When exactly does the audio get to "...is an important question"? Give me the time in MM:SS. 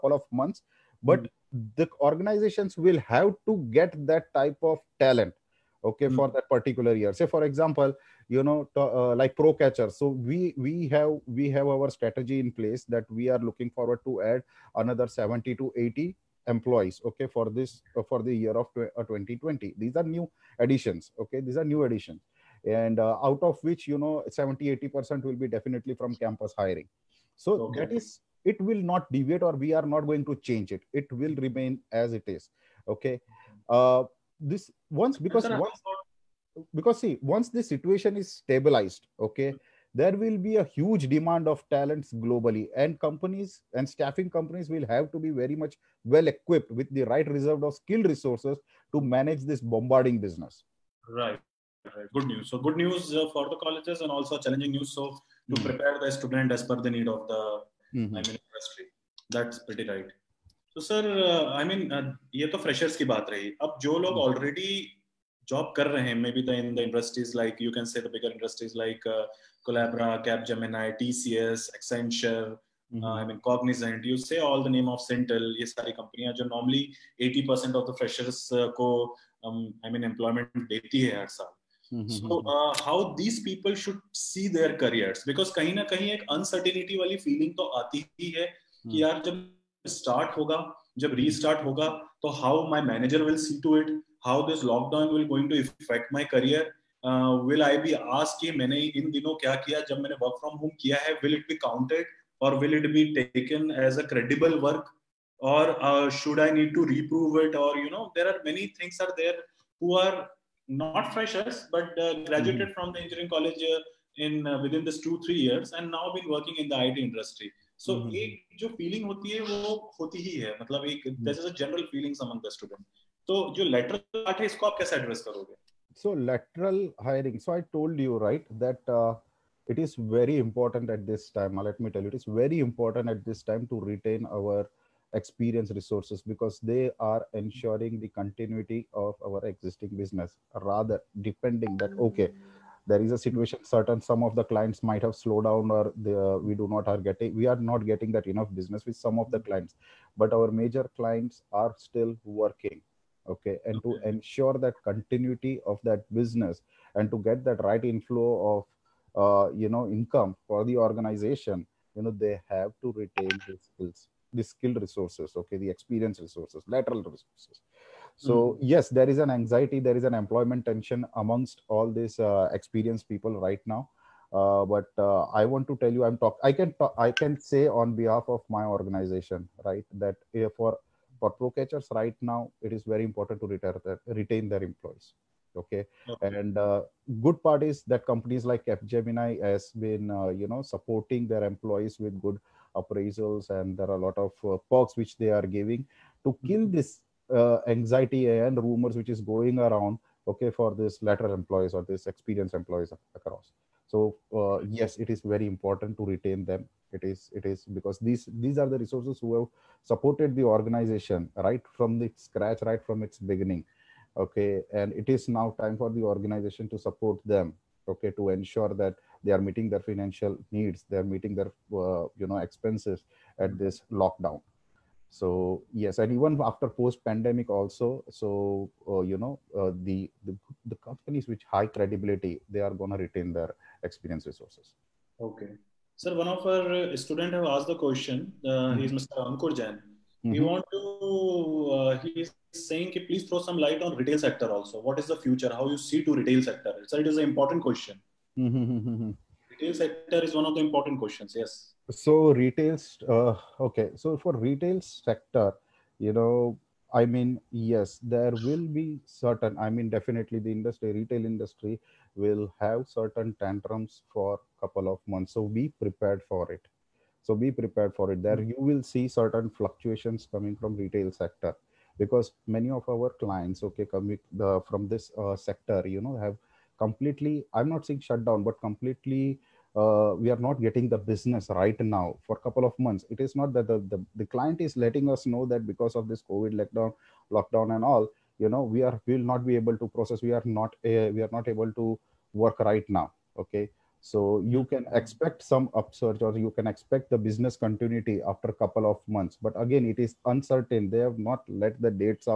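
04:07.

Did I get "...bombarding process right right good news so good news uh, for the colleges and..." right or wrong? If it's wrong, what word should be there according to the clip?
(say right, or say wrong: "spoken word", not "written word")
wrong: "business", not "process".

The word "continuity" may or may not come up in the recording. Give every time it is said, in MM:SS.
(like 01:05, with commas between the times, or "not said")
02:18, 02:34, 04:57.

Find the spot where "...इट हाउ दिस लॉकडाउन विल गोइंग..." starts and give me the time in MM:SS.
01:33.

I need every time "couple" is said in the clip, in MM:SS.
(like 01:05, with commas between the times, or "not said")
04:24, 04:42, 04:58.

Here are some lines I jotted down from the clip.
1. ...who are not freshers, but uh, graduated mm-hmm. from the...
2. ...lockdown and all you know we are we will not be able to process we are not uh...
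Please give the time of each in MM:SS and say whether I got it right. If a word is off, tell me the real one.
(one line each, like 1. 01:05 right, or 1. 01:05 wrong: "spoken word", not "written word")
1. 01:49 right
2. 04:47 right.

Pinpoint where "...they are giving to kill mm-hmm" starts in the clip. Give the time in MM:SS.
03:15.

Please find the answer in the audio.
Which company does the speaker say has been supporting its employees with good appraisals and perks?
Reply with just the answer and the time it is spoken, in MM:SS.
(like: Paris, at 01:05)
Gemini, at 03:08.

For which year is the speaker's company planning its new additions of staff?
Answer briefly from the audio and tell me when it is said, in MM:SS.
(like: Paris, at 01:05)
2020, at 00:18.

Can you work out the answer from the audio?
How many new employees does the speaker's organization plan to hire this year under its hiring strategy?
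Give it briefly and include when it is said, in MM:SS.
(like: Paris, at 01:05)
70 to 80, at 00:15.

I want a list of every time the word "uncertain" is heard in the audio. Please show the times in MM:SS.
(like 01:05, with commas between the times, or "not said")
05:00.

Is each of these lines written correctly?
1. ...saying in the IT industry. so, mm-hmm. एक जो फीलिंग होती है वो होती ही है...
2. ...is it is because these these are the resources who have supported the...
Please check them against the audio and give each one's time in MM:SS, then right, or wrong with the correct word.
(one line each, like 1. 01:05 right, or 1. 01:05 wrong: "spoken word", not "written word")
1. 01:56 wrong: "working", not "saying"
2. 03:27 right.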